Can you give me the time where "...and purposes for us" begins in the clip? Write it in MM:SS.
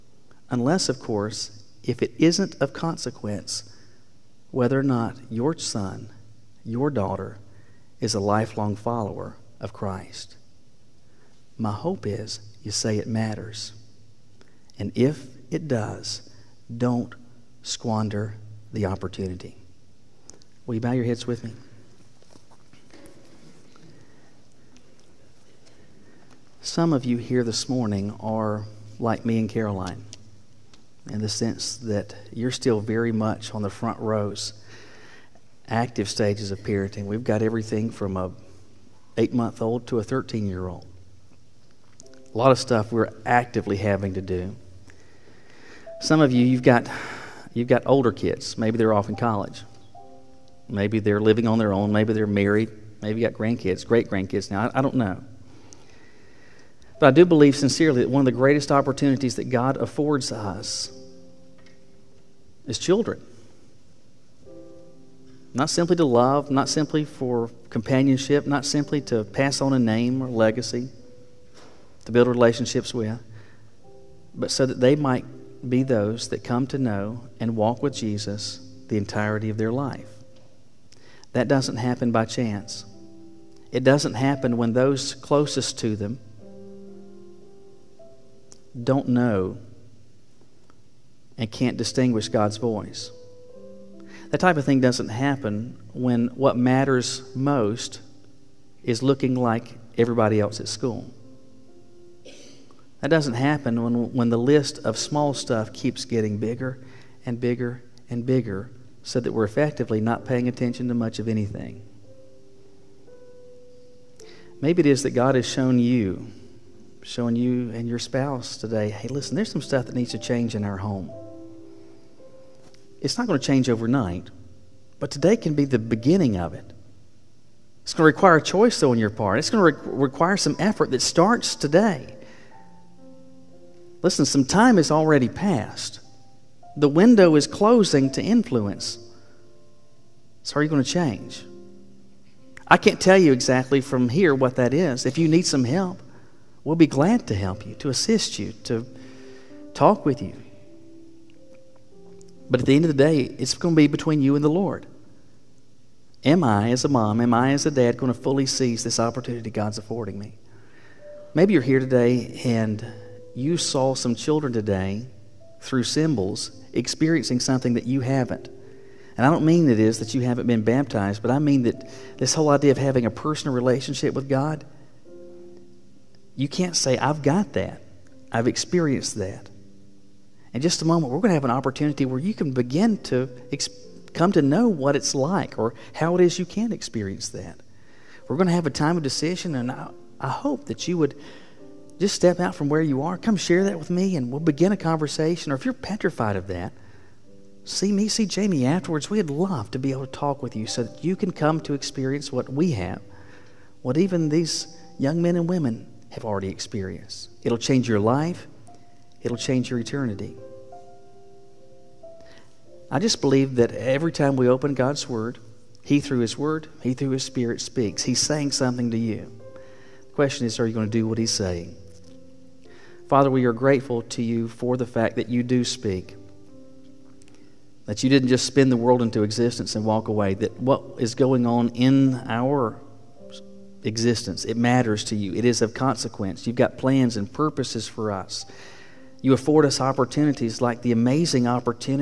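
03:57.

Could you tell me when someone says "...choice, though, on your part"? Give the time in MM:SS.
02:08.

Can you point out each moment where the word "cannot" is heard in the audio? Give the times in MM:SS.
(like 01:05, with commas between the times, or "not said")
not said.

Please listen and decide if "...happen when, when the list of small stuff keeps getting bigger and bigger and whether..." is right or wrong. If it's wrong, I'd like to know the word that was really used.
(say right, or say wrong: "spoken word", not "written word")
wrong: "bigger", not "whether".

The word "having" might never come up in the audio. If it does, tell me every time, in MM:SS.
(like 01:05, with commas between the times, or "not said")
00:43, 02:52.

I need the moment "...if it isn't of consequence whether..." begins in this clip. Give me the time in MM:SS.
00:01.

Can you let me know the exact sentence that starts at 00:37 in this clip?
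We've got everything from a eight month old to a 13 year old.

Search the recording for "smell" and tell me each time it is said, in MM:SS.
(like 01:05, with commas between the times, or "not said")
not said.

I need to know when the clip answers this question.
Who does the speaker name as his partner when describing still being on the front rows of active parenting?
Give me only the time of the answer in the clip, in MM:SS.
00:29.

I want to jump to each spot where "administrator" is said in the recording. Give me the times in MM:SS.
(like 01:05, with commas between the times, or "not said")
not said.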